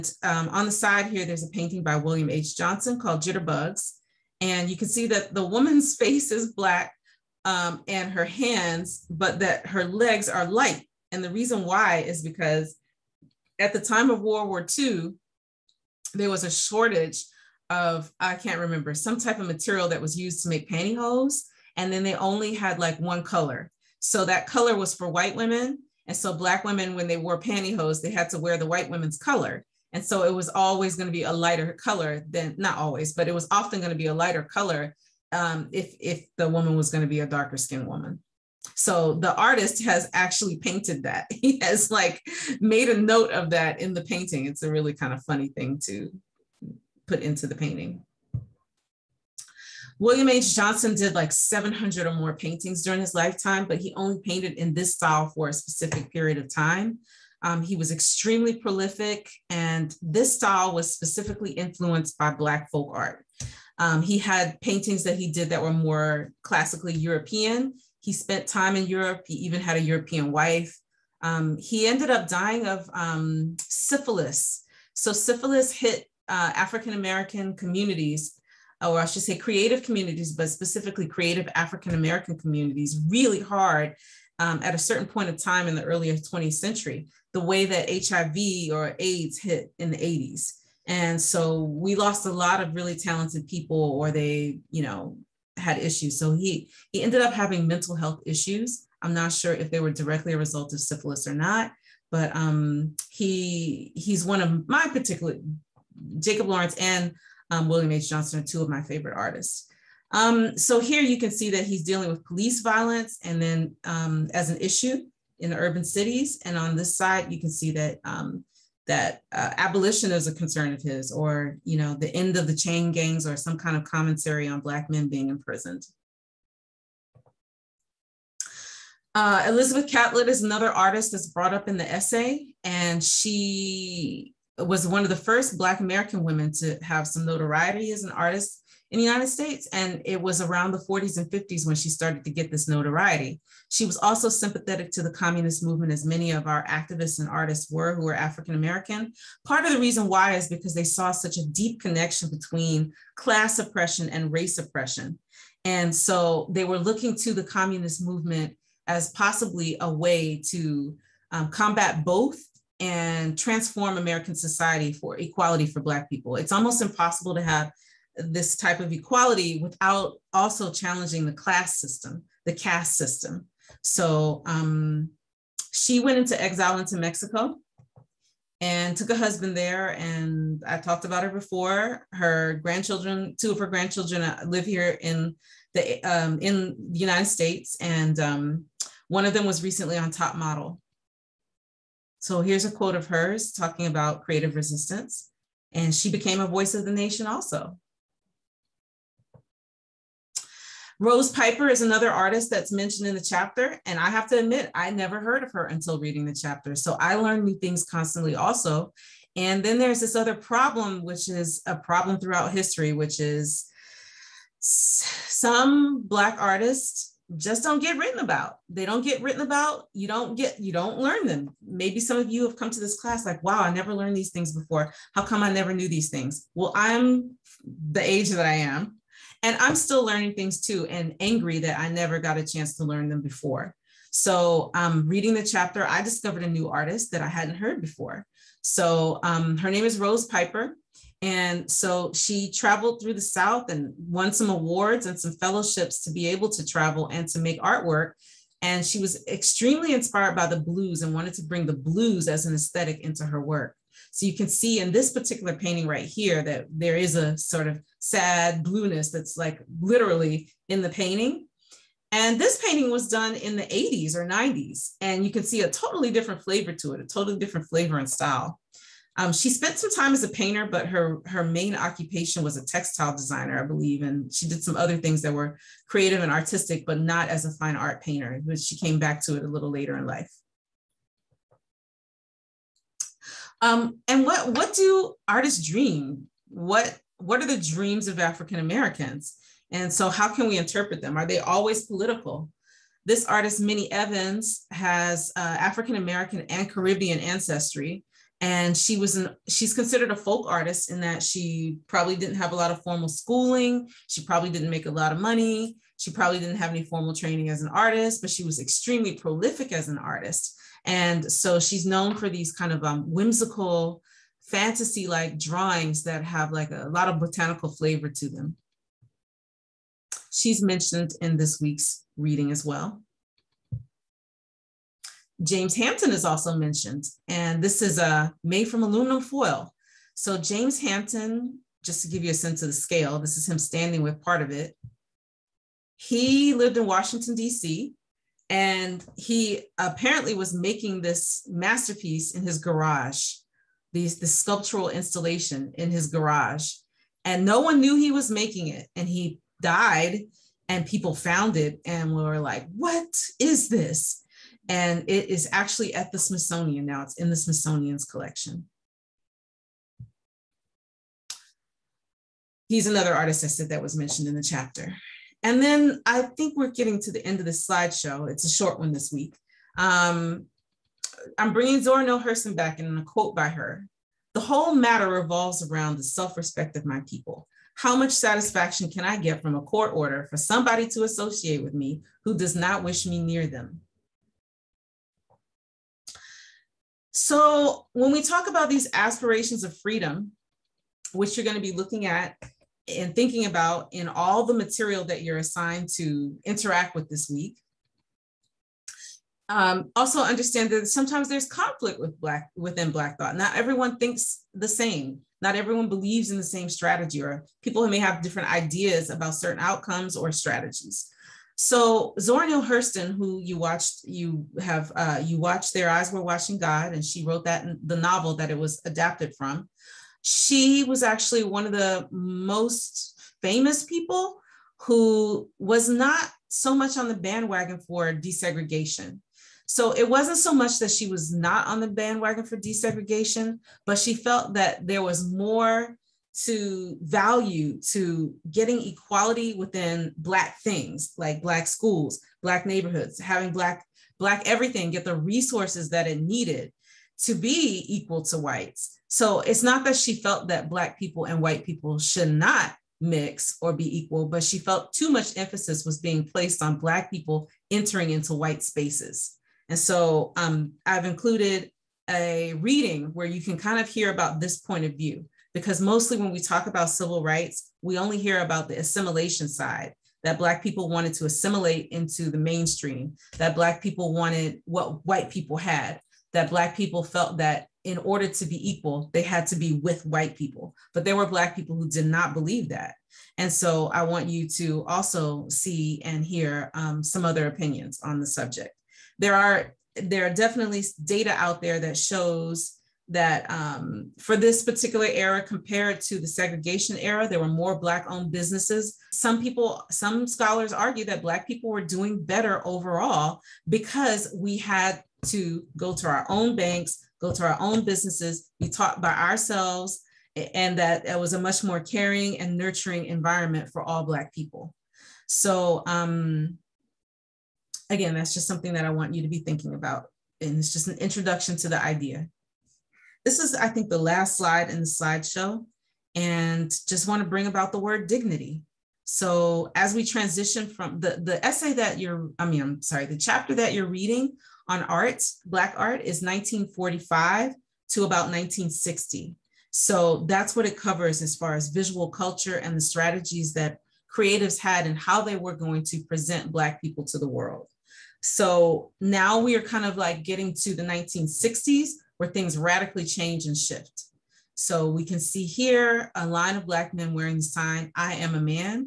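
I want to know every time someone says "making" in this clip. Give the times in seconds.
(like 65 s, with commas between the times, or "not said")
340 s, 348 s.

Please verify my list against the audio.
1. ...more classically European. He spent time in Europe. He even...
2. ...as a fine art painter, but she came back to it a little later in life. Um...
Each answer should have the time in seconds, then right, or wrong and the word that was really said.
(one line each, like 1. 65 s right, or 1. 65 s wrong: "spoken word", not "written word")
1. 65 s right
2. 277 s right.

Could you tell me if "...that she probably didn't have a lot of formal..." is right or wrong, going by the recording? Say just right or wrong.
right.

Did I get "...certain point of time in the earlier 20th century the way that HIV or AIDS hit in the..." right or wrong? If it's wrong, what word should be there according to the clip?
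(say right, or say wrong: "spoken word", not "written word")
right.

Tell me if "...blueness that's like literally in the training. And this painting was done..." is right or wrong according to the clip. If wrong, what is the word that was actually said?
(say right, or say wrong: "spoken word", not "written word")
wrong: "painting", not "training".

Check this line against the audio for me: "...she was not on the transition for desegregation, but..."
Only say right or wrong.
wrong.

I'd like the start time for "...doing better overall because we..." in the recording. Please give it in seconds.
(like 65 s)
501 s.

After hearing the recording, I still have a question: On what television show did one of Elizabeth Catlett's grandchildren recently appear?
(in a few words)
Top Model.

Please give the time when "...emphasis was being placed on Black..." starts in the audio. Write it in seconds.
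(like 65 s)
455 s.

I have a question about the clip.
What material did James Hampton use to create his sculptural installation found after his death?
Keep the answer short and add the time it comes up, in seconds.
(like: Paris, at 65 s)
aluminum foil, at 328 s.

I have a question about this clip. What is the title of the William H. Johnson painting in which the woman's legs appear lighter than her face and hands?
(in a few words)
Jitterbugs.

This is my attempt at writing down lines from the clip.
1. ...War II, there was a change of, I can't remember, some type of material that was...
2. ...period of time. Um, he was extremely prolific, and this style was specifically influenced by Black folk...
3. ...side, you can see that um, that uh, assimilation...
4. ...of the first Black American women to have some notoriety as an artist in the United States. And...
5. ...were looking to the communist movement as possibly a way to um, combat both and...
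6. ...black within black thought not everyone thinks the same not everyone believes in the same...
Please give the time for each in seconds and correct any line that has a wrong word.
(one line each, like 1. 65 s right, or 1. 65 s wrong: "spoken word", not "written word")
1. 14 s wrong: "shortage", not "change"
2. 56 s right
3. 116 s wrong: "abolition", not "assimilation"
4. 135 s right
5. 156 s right
6. 402 s right.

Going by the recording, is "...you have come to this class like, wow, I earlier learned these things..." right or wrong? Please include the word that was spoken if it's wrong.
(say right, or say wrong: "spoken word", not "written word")
wrong: "never", not "earlier".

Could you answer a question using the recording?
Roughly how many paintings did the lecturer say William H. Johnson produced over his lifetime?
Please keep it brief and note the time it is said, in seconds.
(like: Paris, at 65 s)
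700, at 51 s.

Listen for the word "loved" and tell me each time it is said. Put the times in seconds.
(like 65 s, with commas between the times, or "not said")
not said.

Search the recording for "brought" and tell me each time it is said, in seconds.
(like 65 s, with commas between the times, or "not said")
131 s.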